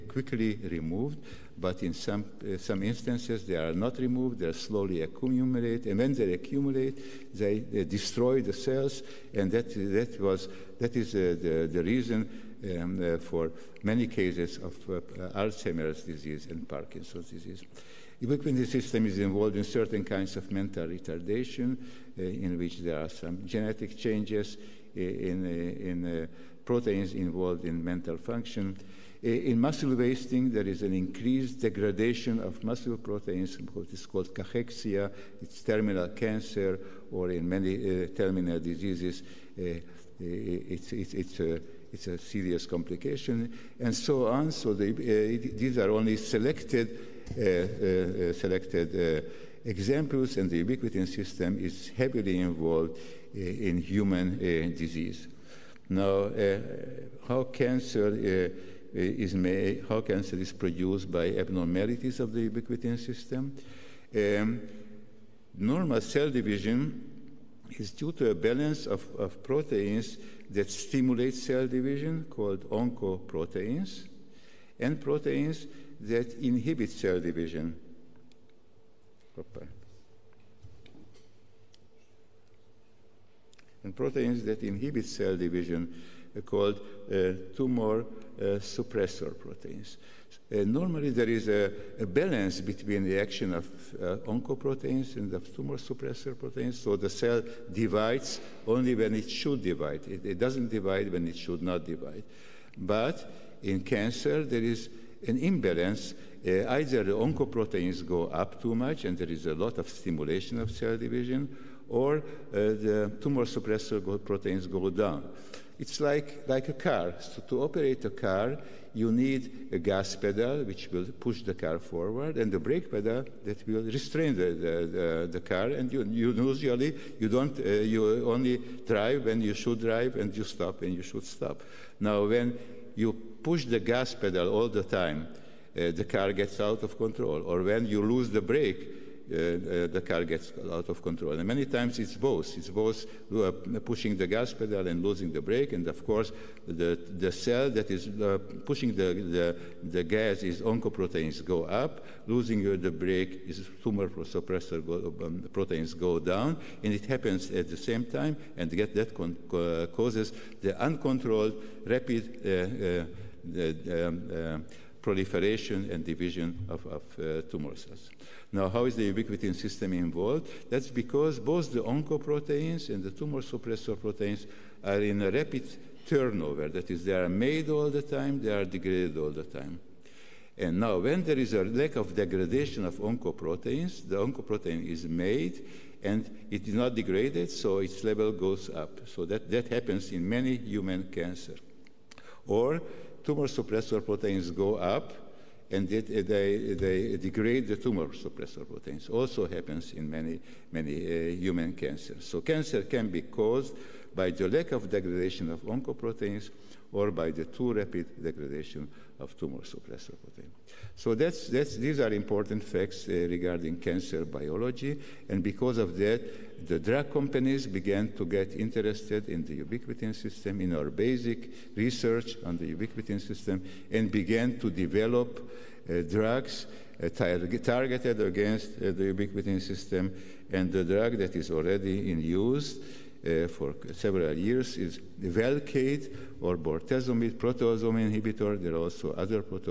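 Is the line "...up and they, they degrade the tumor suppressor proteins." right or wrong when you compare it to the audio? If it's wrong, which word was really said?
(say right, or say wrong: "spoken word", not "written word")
right.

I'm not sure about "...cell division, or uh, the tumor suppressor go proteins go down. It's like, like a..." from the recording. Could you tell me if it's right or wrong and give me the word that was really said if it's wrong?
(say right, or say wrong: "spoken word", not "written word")
right.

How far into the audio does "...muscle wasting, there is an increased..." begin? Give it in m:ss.
0:29.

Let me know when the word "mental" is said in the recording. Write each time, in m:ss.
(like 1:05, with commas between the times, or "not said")
0:20, 0:27.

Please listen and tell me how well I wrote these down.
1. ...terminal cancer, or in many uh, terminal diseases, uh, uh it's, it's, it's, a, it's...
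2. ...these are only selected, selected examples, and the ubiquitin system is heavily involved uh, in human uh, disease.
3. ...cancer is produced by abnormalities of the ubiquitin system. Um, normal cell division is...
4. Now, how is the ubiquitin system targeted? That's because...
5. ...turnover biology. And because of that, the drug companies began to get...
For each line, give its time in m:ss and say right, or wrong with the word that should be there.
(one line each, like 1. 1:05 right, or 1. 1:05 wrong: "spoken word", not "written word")
1. 0:35 right
2. 0:45 right
3. 1:00 right
4. 2:48 wrong: "involved", not "targeted"
5. 3:33 wrong: "cancer", not "turnover".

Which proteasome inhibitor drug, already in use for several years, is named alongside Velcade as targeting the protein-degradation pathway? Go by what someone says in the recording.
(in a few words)
bortezomib.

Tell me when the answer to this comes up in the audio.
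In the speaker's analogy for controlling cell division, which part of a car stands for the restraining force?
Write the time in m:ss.
2:02.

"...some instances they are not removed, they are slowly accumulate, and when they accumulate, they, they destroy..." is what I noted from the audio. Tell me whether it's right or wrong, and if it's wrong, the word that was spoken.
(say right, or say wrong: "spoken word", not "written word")
right.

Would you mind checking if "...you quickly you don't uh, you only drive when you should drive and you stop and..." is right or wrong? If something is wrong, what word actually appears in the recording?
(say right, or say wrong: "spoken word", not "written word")
wrong: "usually", not "quickly".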